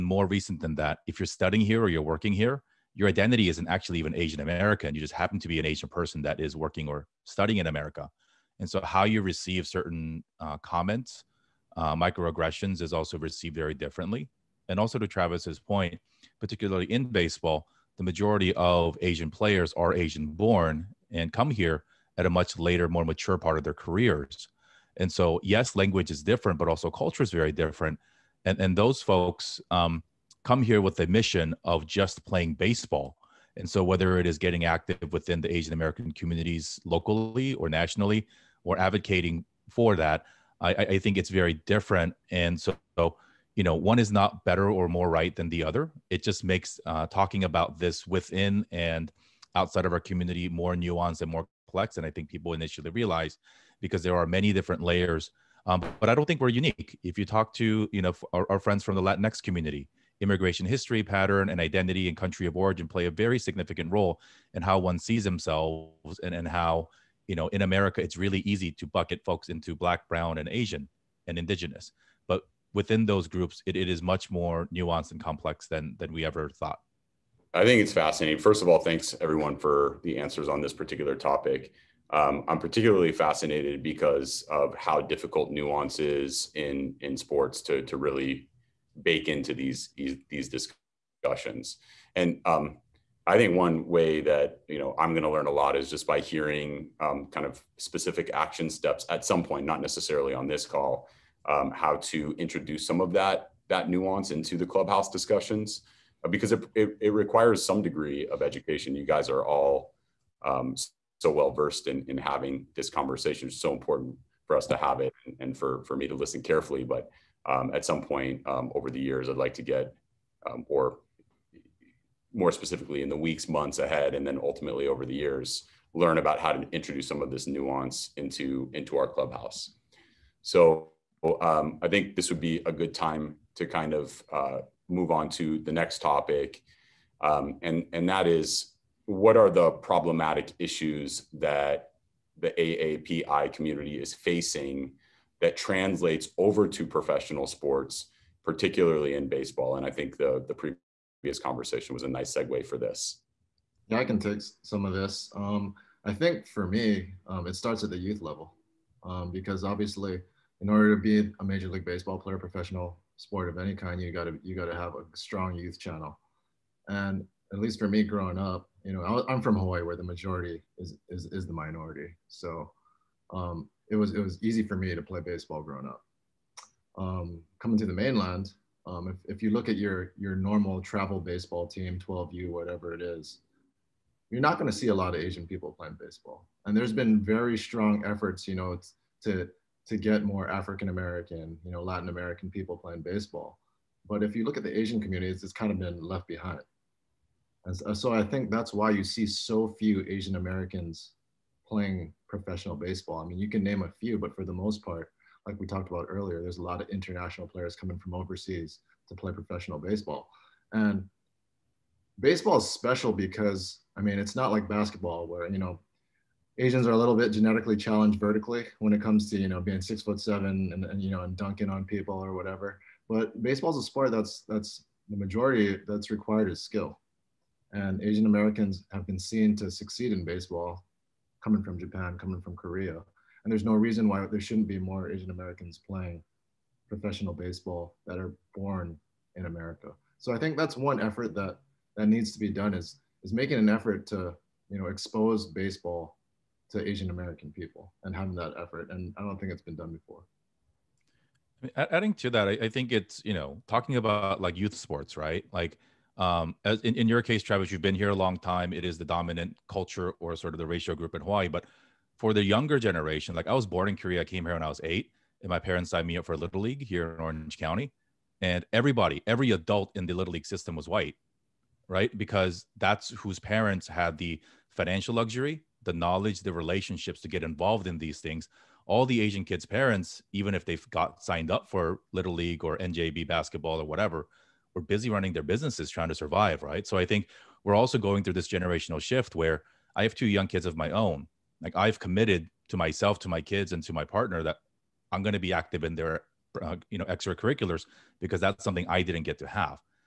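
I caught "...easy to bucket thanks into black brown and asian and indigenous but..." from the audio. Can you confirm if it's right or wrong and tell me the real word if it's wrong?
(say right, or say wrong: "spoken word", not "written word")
wrong: "folks", not "thanks".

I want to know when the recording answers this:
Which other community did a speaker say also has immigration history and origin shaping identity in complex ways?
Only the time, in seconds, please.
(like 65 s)
59 s.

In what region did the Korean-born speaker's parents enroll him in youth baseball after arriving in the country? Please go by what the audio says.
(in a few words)
Orange County.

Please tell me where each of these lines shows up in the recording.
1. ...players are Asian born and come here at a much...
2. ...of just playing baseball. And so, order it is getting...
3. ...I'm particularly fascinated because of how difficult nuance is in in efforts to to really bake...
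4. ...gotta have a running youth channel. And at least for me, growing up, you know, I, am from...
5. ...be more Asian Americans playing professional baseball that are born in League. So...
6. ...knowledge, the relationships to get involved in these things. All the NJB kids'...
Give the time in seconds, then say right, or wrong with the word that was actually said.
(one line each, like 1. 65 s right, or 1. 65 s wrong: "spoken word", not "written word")
1. 19 s right
2. 31 s wrong: "whether", not "order"
3. 82 s wrong: "sports", not "efforts"
4. 164 s wrong: "strong", not "running"
5. 234 s wrong: "America", not "League"
6. 275 s wrong: "Asian", not "NJB".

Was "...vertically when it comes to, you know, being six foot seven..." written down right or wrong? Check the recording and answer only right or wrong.
right.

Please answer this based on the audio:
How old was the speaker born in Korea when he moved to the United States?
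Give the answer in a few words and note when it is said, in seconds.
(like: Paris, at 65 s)
8, at 264 s.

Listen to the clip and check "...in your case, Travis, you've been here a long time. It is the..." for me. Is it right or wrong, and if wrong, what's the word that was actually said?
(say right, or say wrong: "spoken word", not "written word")
right.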